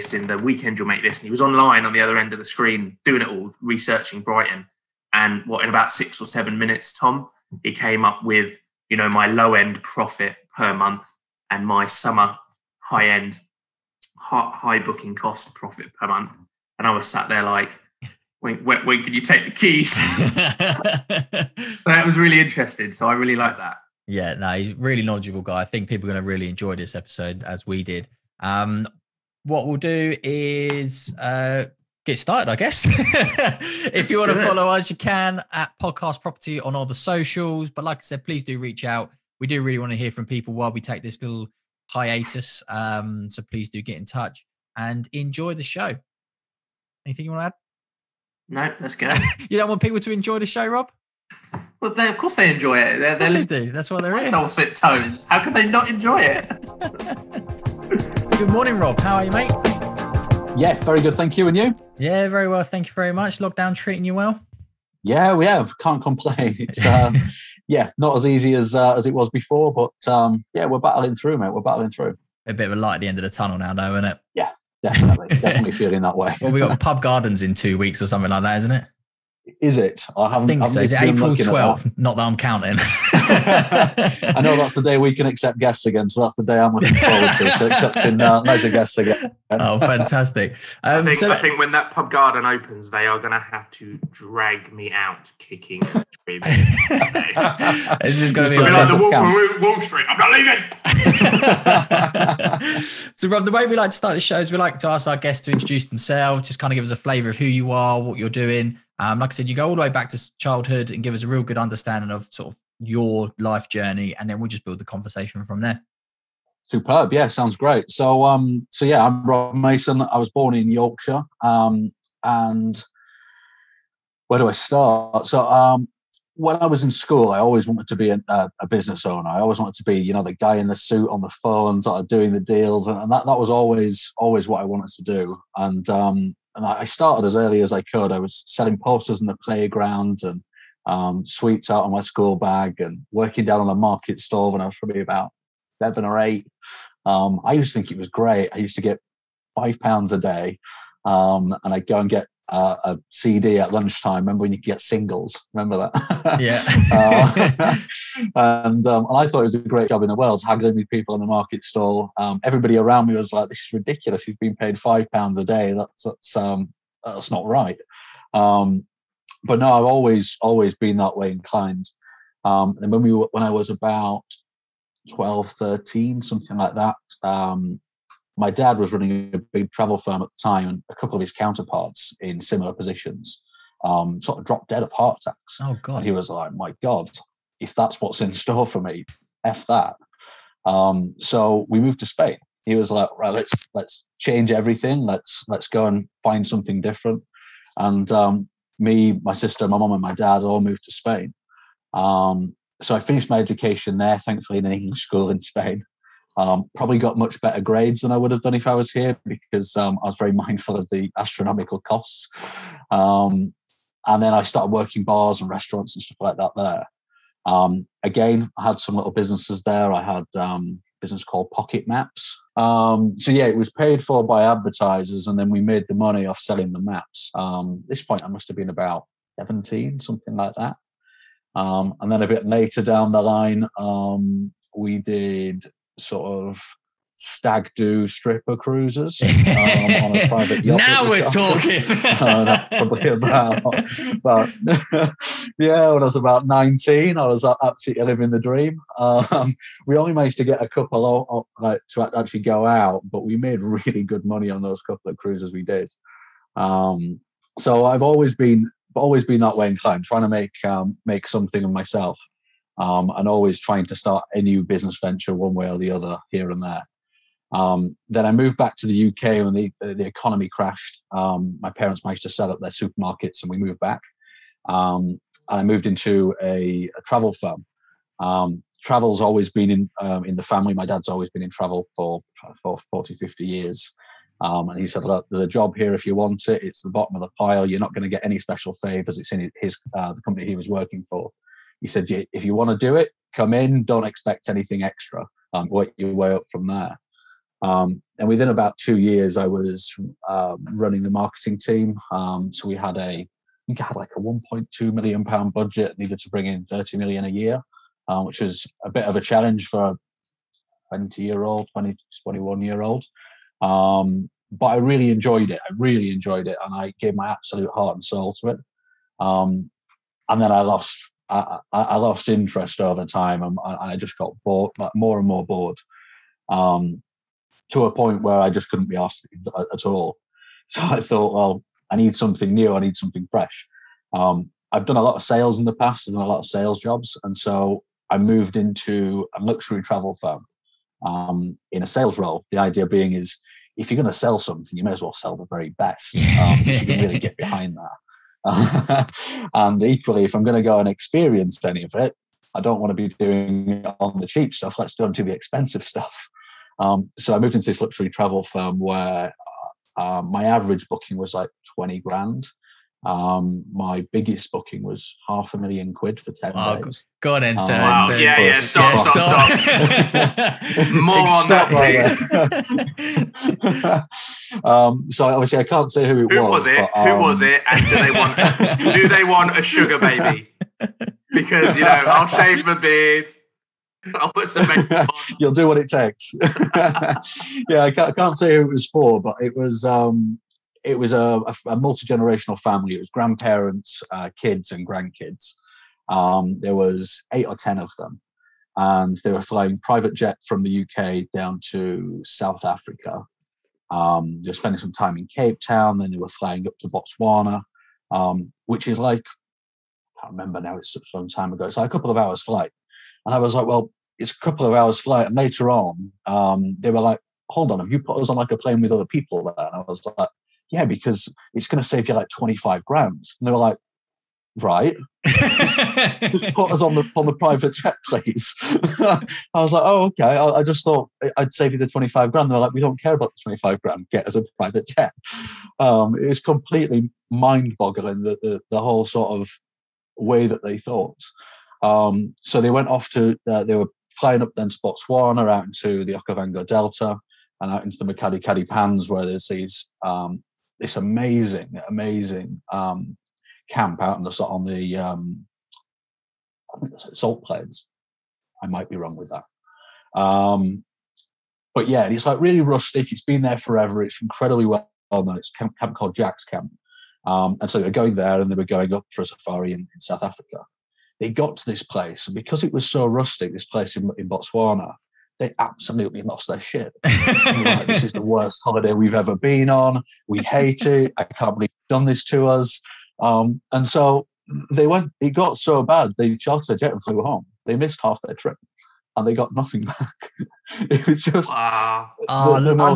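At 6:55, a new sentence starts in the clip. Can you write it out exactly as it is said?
And later on, um, they were like, hold on, have you put us on like a plane with other people there?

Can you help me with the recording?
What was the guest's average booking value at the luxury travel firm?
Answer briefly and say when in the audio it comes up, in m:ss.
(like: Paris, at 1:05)
20 grand, at 6:01.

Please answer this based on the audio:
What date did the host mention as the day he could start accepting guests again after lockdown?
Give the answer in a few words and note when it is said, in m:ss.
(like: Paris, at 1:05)
April 12th, at 1:21.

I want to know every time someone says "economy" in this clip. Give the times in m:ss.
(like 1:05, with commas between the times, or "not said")
4:30.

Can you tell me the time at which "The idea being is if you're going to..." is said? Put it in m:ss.
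5:42.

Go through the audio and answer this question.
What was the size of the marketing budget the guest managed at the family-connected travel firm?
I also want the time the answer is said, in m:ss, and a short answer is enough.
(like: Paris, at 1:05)
1.2 million pounds, at 5:04.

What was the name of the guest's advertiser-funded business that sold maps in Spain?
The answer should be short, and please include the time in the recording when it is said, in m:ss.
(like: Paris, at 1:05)
Pocket Maps, at 3:41.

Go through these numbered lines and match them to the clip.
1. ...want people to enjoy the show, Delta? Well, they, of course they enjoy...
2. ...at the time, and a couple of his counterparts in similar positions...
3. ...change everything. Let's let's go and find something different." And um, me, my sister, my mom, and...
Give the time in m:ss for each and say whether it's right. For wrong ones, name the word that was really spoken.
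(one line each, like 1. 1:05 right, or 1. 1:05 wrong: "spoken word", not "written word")
1. 0:49 wrong: "Rob", not "Delta"
2. 3:00 right
3. 3:14 right.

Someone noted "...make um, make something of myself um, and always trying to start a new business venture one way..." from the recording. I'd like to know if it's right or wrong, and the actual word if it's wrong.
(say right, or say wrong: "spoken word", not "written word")
right.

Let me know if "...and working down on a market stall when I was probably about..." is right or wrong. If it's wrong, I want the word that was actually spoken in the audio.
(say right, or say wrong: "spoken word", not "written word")
right.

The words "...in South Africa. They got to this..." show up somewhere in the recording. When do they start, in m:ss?
7:49.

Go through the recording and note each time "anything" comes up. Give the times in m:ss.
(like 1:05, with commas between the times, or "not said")
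0:47, 4:54.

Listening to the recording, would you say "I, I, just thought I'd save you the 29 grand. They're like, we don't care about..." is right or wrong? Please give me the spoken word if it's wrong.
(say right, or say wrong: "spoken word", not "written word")
wrong: "25", not "29".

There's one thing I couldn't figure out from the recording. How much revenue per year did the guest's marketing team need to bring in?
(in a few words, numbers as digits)
30 million.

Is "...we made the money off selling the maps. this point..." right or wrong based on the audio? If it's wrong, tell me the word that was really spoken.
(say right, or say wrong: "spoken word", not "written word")
right.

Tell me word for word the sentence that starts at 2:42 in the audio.
Um, everybody around me was like, "This is ridiculous.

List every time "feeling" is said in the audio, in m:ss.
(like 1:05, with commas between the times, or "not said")
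1:15.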